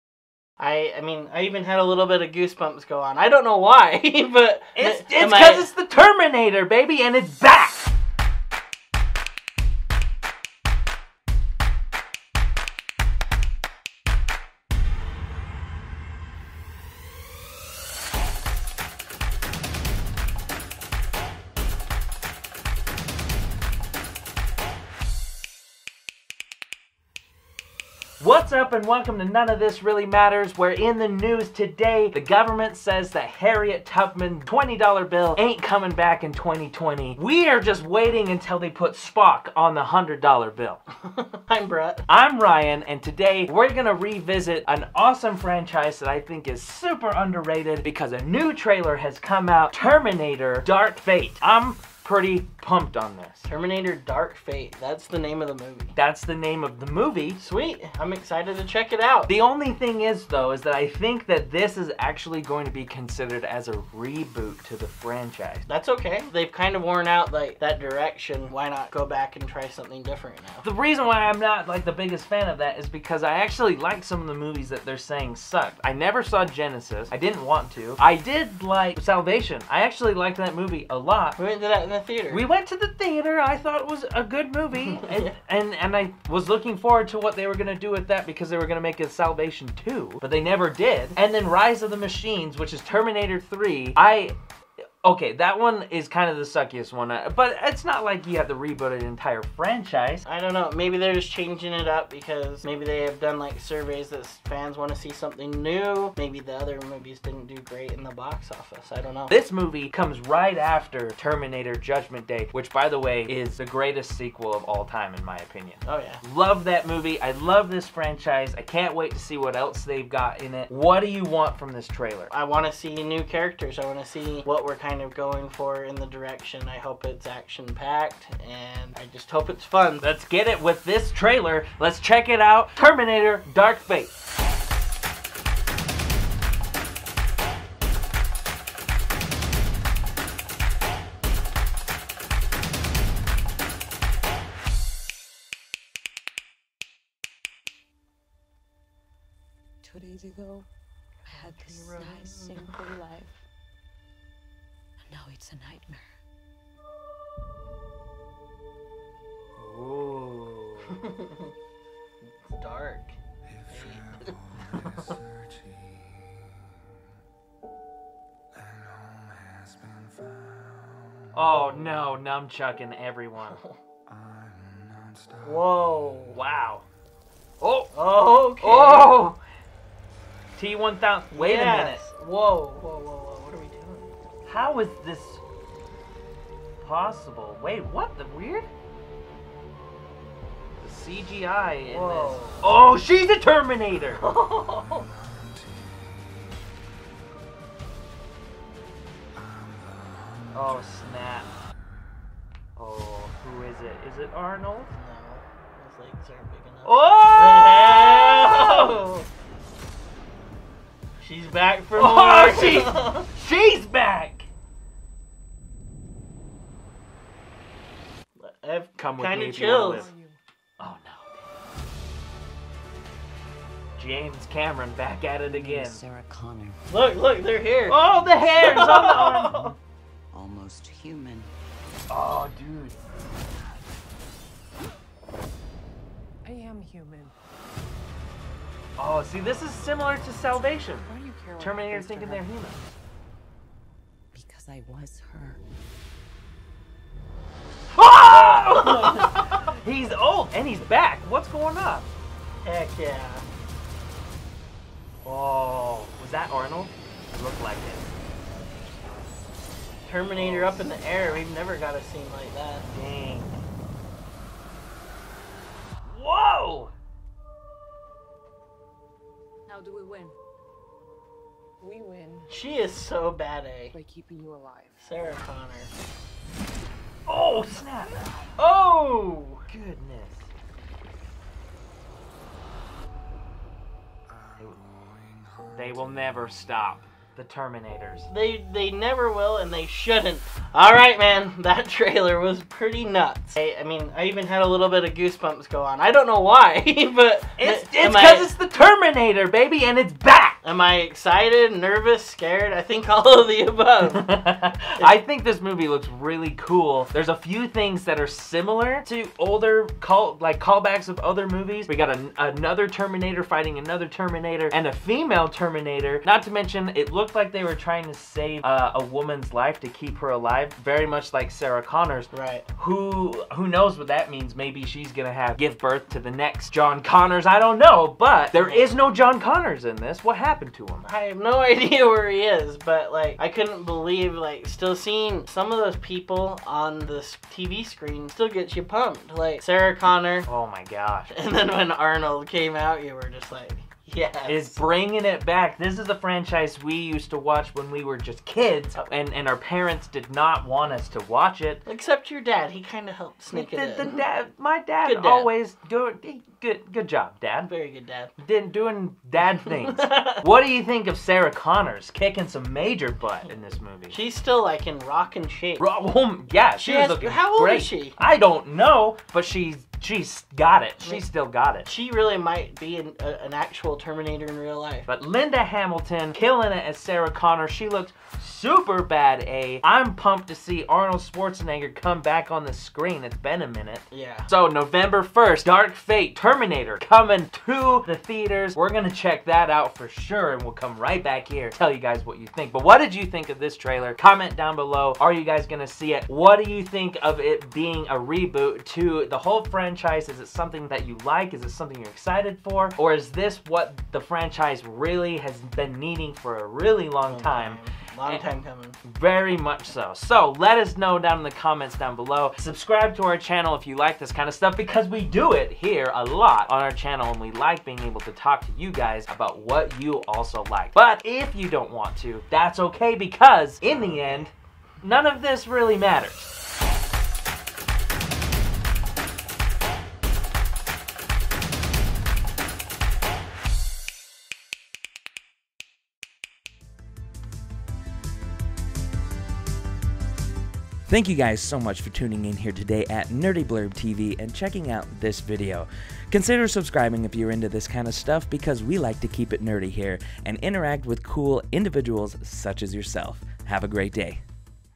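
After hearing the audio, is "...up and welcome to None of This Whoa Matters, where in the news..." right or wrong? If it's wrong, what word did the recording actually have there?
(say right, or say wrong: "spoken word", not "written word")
wrong: "Really", not "Whoa".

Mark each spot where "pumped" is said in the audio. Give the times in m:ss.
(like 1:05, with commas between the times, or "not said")
0:52, 5:38, 6:20.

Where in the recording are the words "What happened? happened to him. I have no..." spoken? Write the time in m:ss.
5:30.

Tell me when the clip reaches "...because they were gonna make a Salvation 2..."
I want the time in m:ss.
1:28.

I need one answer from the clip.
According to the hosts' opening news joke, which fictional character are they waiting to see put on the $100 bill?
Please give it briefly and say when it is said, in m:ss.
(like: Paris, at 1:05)
Spock, at 0:38.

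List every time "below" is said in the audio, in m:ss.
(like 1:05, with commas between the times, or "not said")
6:34, 6:52.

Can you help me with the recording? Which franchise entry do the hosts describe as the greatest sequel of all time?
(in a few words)
Terminator Judgment Day.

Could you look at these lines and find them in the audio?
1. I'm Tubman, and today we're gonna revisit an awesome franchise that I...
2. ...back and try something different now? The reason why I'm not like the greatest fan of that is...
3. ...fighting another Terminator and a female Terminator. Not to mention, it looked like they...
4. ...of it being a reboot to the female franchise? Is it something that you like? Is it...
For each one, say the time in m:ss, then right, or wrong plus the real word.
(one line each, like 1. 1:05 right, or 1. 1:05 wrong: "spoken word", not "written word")
1. 0:42 wrong: "Ryan", not "Tubman"
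2. 1:09 wrong: "biggest", not "greatest"
3. 5:13 right
4. 6:37 wrong: "whole", not "female".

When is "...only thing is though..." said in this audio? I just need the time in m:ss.
0:59.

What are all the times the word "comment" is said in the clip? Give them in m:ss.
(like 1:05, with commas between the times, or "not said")
6:34, 6:51.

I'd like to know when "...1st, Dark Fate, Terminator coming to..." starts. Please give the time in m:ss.
6:25.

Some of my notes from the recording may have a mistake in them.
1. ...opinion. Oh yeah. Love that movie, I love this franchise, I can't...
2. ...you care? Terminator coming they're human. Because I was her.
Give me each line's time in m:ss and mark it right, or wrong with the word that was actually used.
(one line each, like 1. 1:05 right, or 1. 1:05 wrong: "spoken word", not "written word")
1. 1:55 right
2. 4:01 wrong: "thinking", not "coming".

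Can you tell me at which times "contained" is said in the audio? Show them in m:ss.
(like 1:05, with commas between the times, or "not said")
not said.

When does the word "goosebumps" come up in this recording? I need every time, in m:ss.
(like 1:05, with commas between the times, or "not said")
0:02, 4:55.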